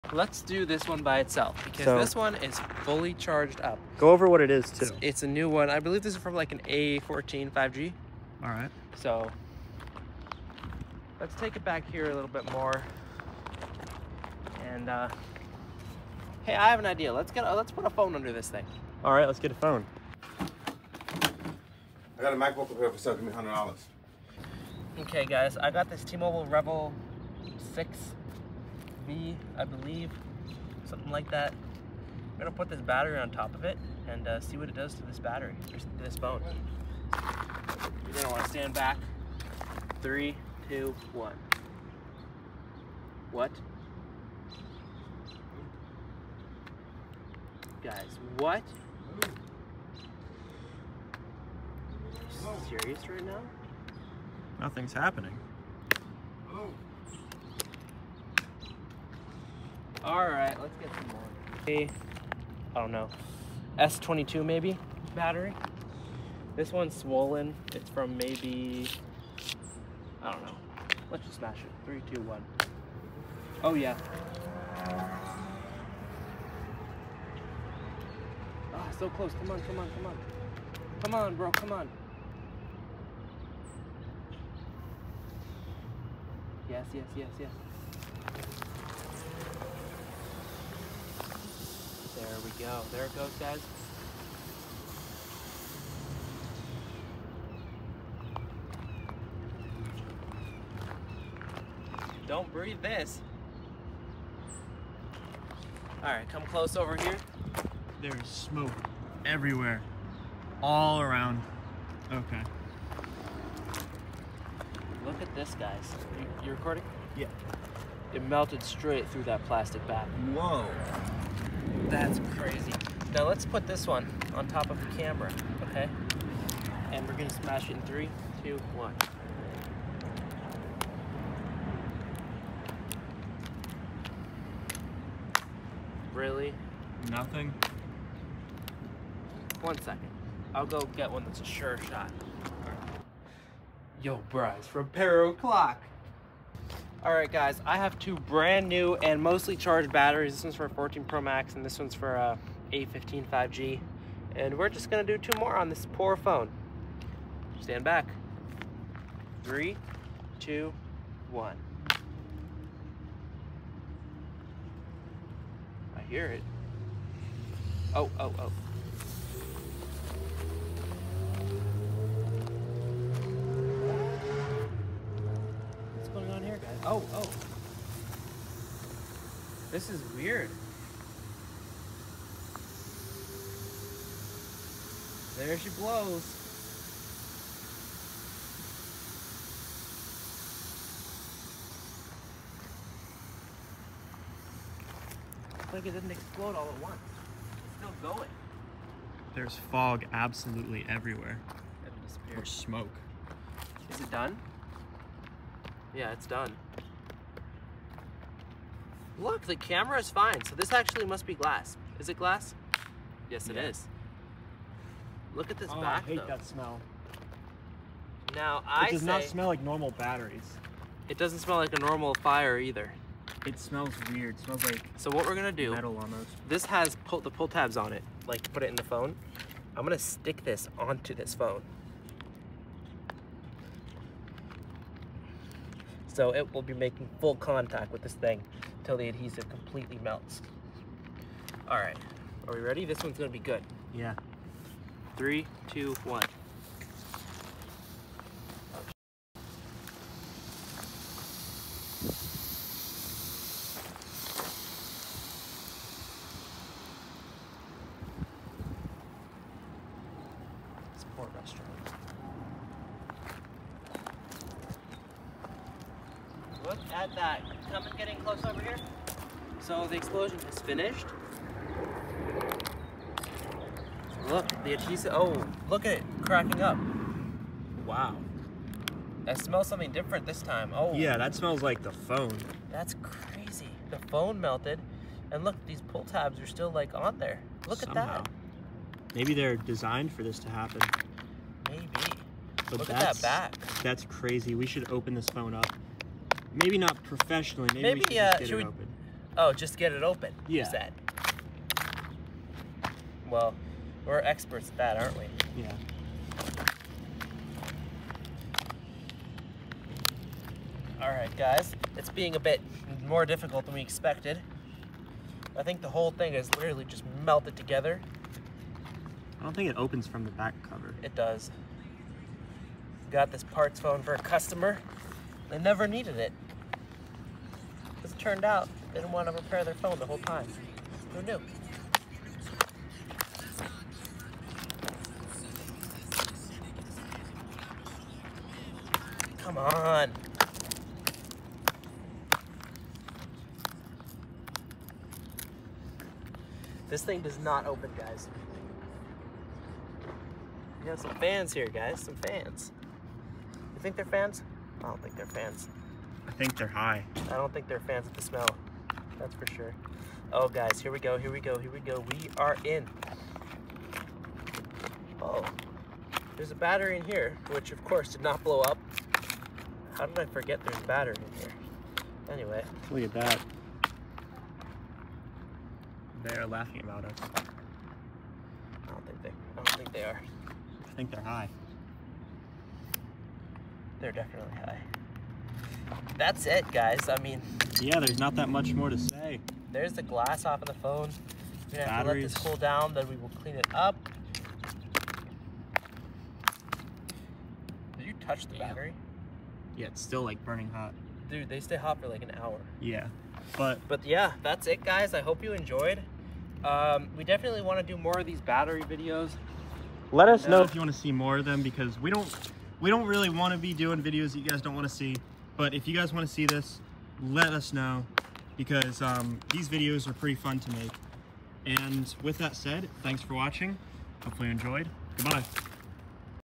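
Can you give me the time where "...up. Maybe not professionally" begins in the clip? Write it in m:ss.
4:55.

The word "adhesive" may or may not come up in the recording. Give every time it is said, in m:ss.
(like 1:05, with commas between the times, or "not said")
3:59, 4:34.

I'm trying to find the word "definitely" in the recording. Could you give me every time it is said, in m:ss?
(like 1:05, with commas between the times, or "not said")
6:24, 6:47.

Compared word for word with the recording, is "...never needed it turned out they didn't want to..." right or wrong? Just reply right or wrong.
right.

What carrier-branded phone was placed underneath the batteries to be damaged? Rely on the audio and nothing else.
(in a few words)
T-Mobile REVVL Six.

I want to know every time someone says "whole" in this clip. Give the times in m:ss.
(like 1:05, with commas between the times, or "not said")
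5:15, 5:30.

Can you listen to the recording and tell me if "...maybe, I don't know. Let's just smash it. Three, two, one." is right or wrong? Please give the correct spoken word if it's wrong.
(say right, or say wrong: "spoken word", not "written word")
right.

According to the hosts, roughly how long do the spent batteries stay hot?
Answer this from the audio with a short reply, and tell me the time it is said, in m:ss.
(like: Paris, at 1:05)
an hour, at 6:42.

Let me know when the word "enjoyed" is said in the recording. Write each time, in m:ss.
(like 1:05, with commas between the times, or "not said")
6:45, 7:04.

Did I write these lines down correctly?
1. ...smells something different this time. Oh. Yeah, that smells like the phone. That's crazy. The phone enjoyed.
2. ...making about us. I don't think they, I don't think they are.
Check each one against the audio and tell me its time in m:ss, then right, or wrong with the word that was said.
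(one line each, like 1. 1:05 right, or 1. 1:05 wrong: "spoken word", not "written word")
1. 4:39 wrong: "melted", not "enjoyed"
2. 6:16 wrong: "laughing", not "making".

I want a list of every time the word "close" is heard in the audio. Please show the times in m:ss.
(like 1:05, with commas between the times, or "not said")
1:19, 1:46, 4:28.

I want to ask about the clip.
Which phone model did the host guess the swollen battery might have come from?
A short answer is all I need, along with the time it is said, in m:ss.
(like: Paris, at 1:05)
S22, at 1:03.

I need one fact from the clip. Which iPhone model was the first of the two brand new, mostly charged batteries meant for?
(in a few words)
14 Pro Max.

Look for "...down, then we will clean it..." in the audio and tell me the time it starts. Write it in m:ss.
6:32.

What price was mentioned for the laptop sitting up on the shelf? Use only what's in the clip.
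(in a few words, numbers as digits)
$700.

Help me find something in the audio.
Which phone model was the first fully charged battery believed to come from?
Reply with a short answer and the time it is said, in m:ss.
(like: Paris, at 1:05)
A14 5G, at 0:06.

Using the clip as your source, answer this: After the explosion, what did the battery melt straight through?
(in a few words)
plastic bag.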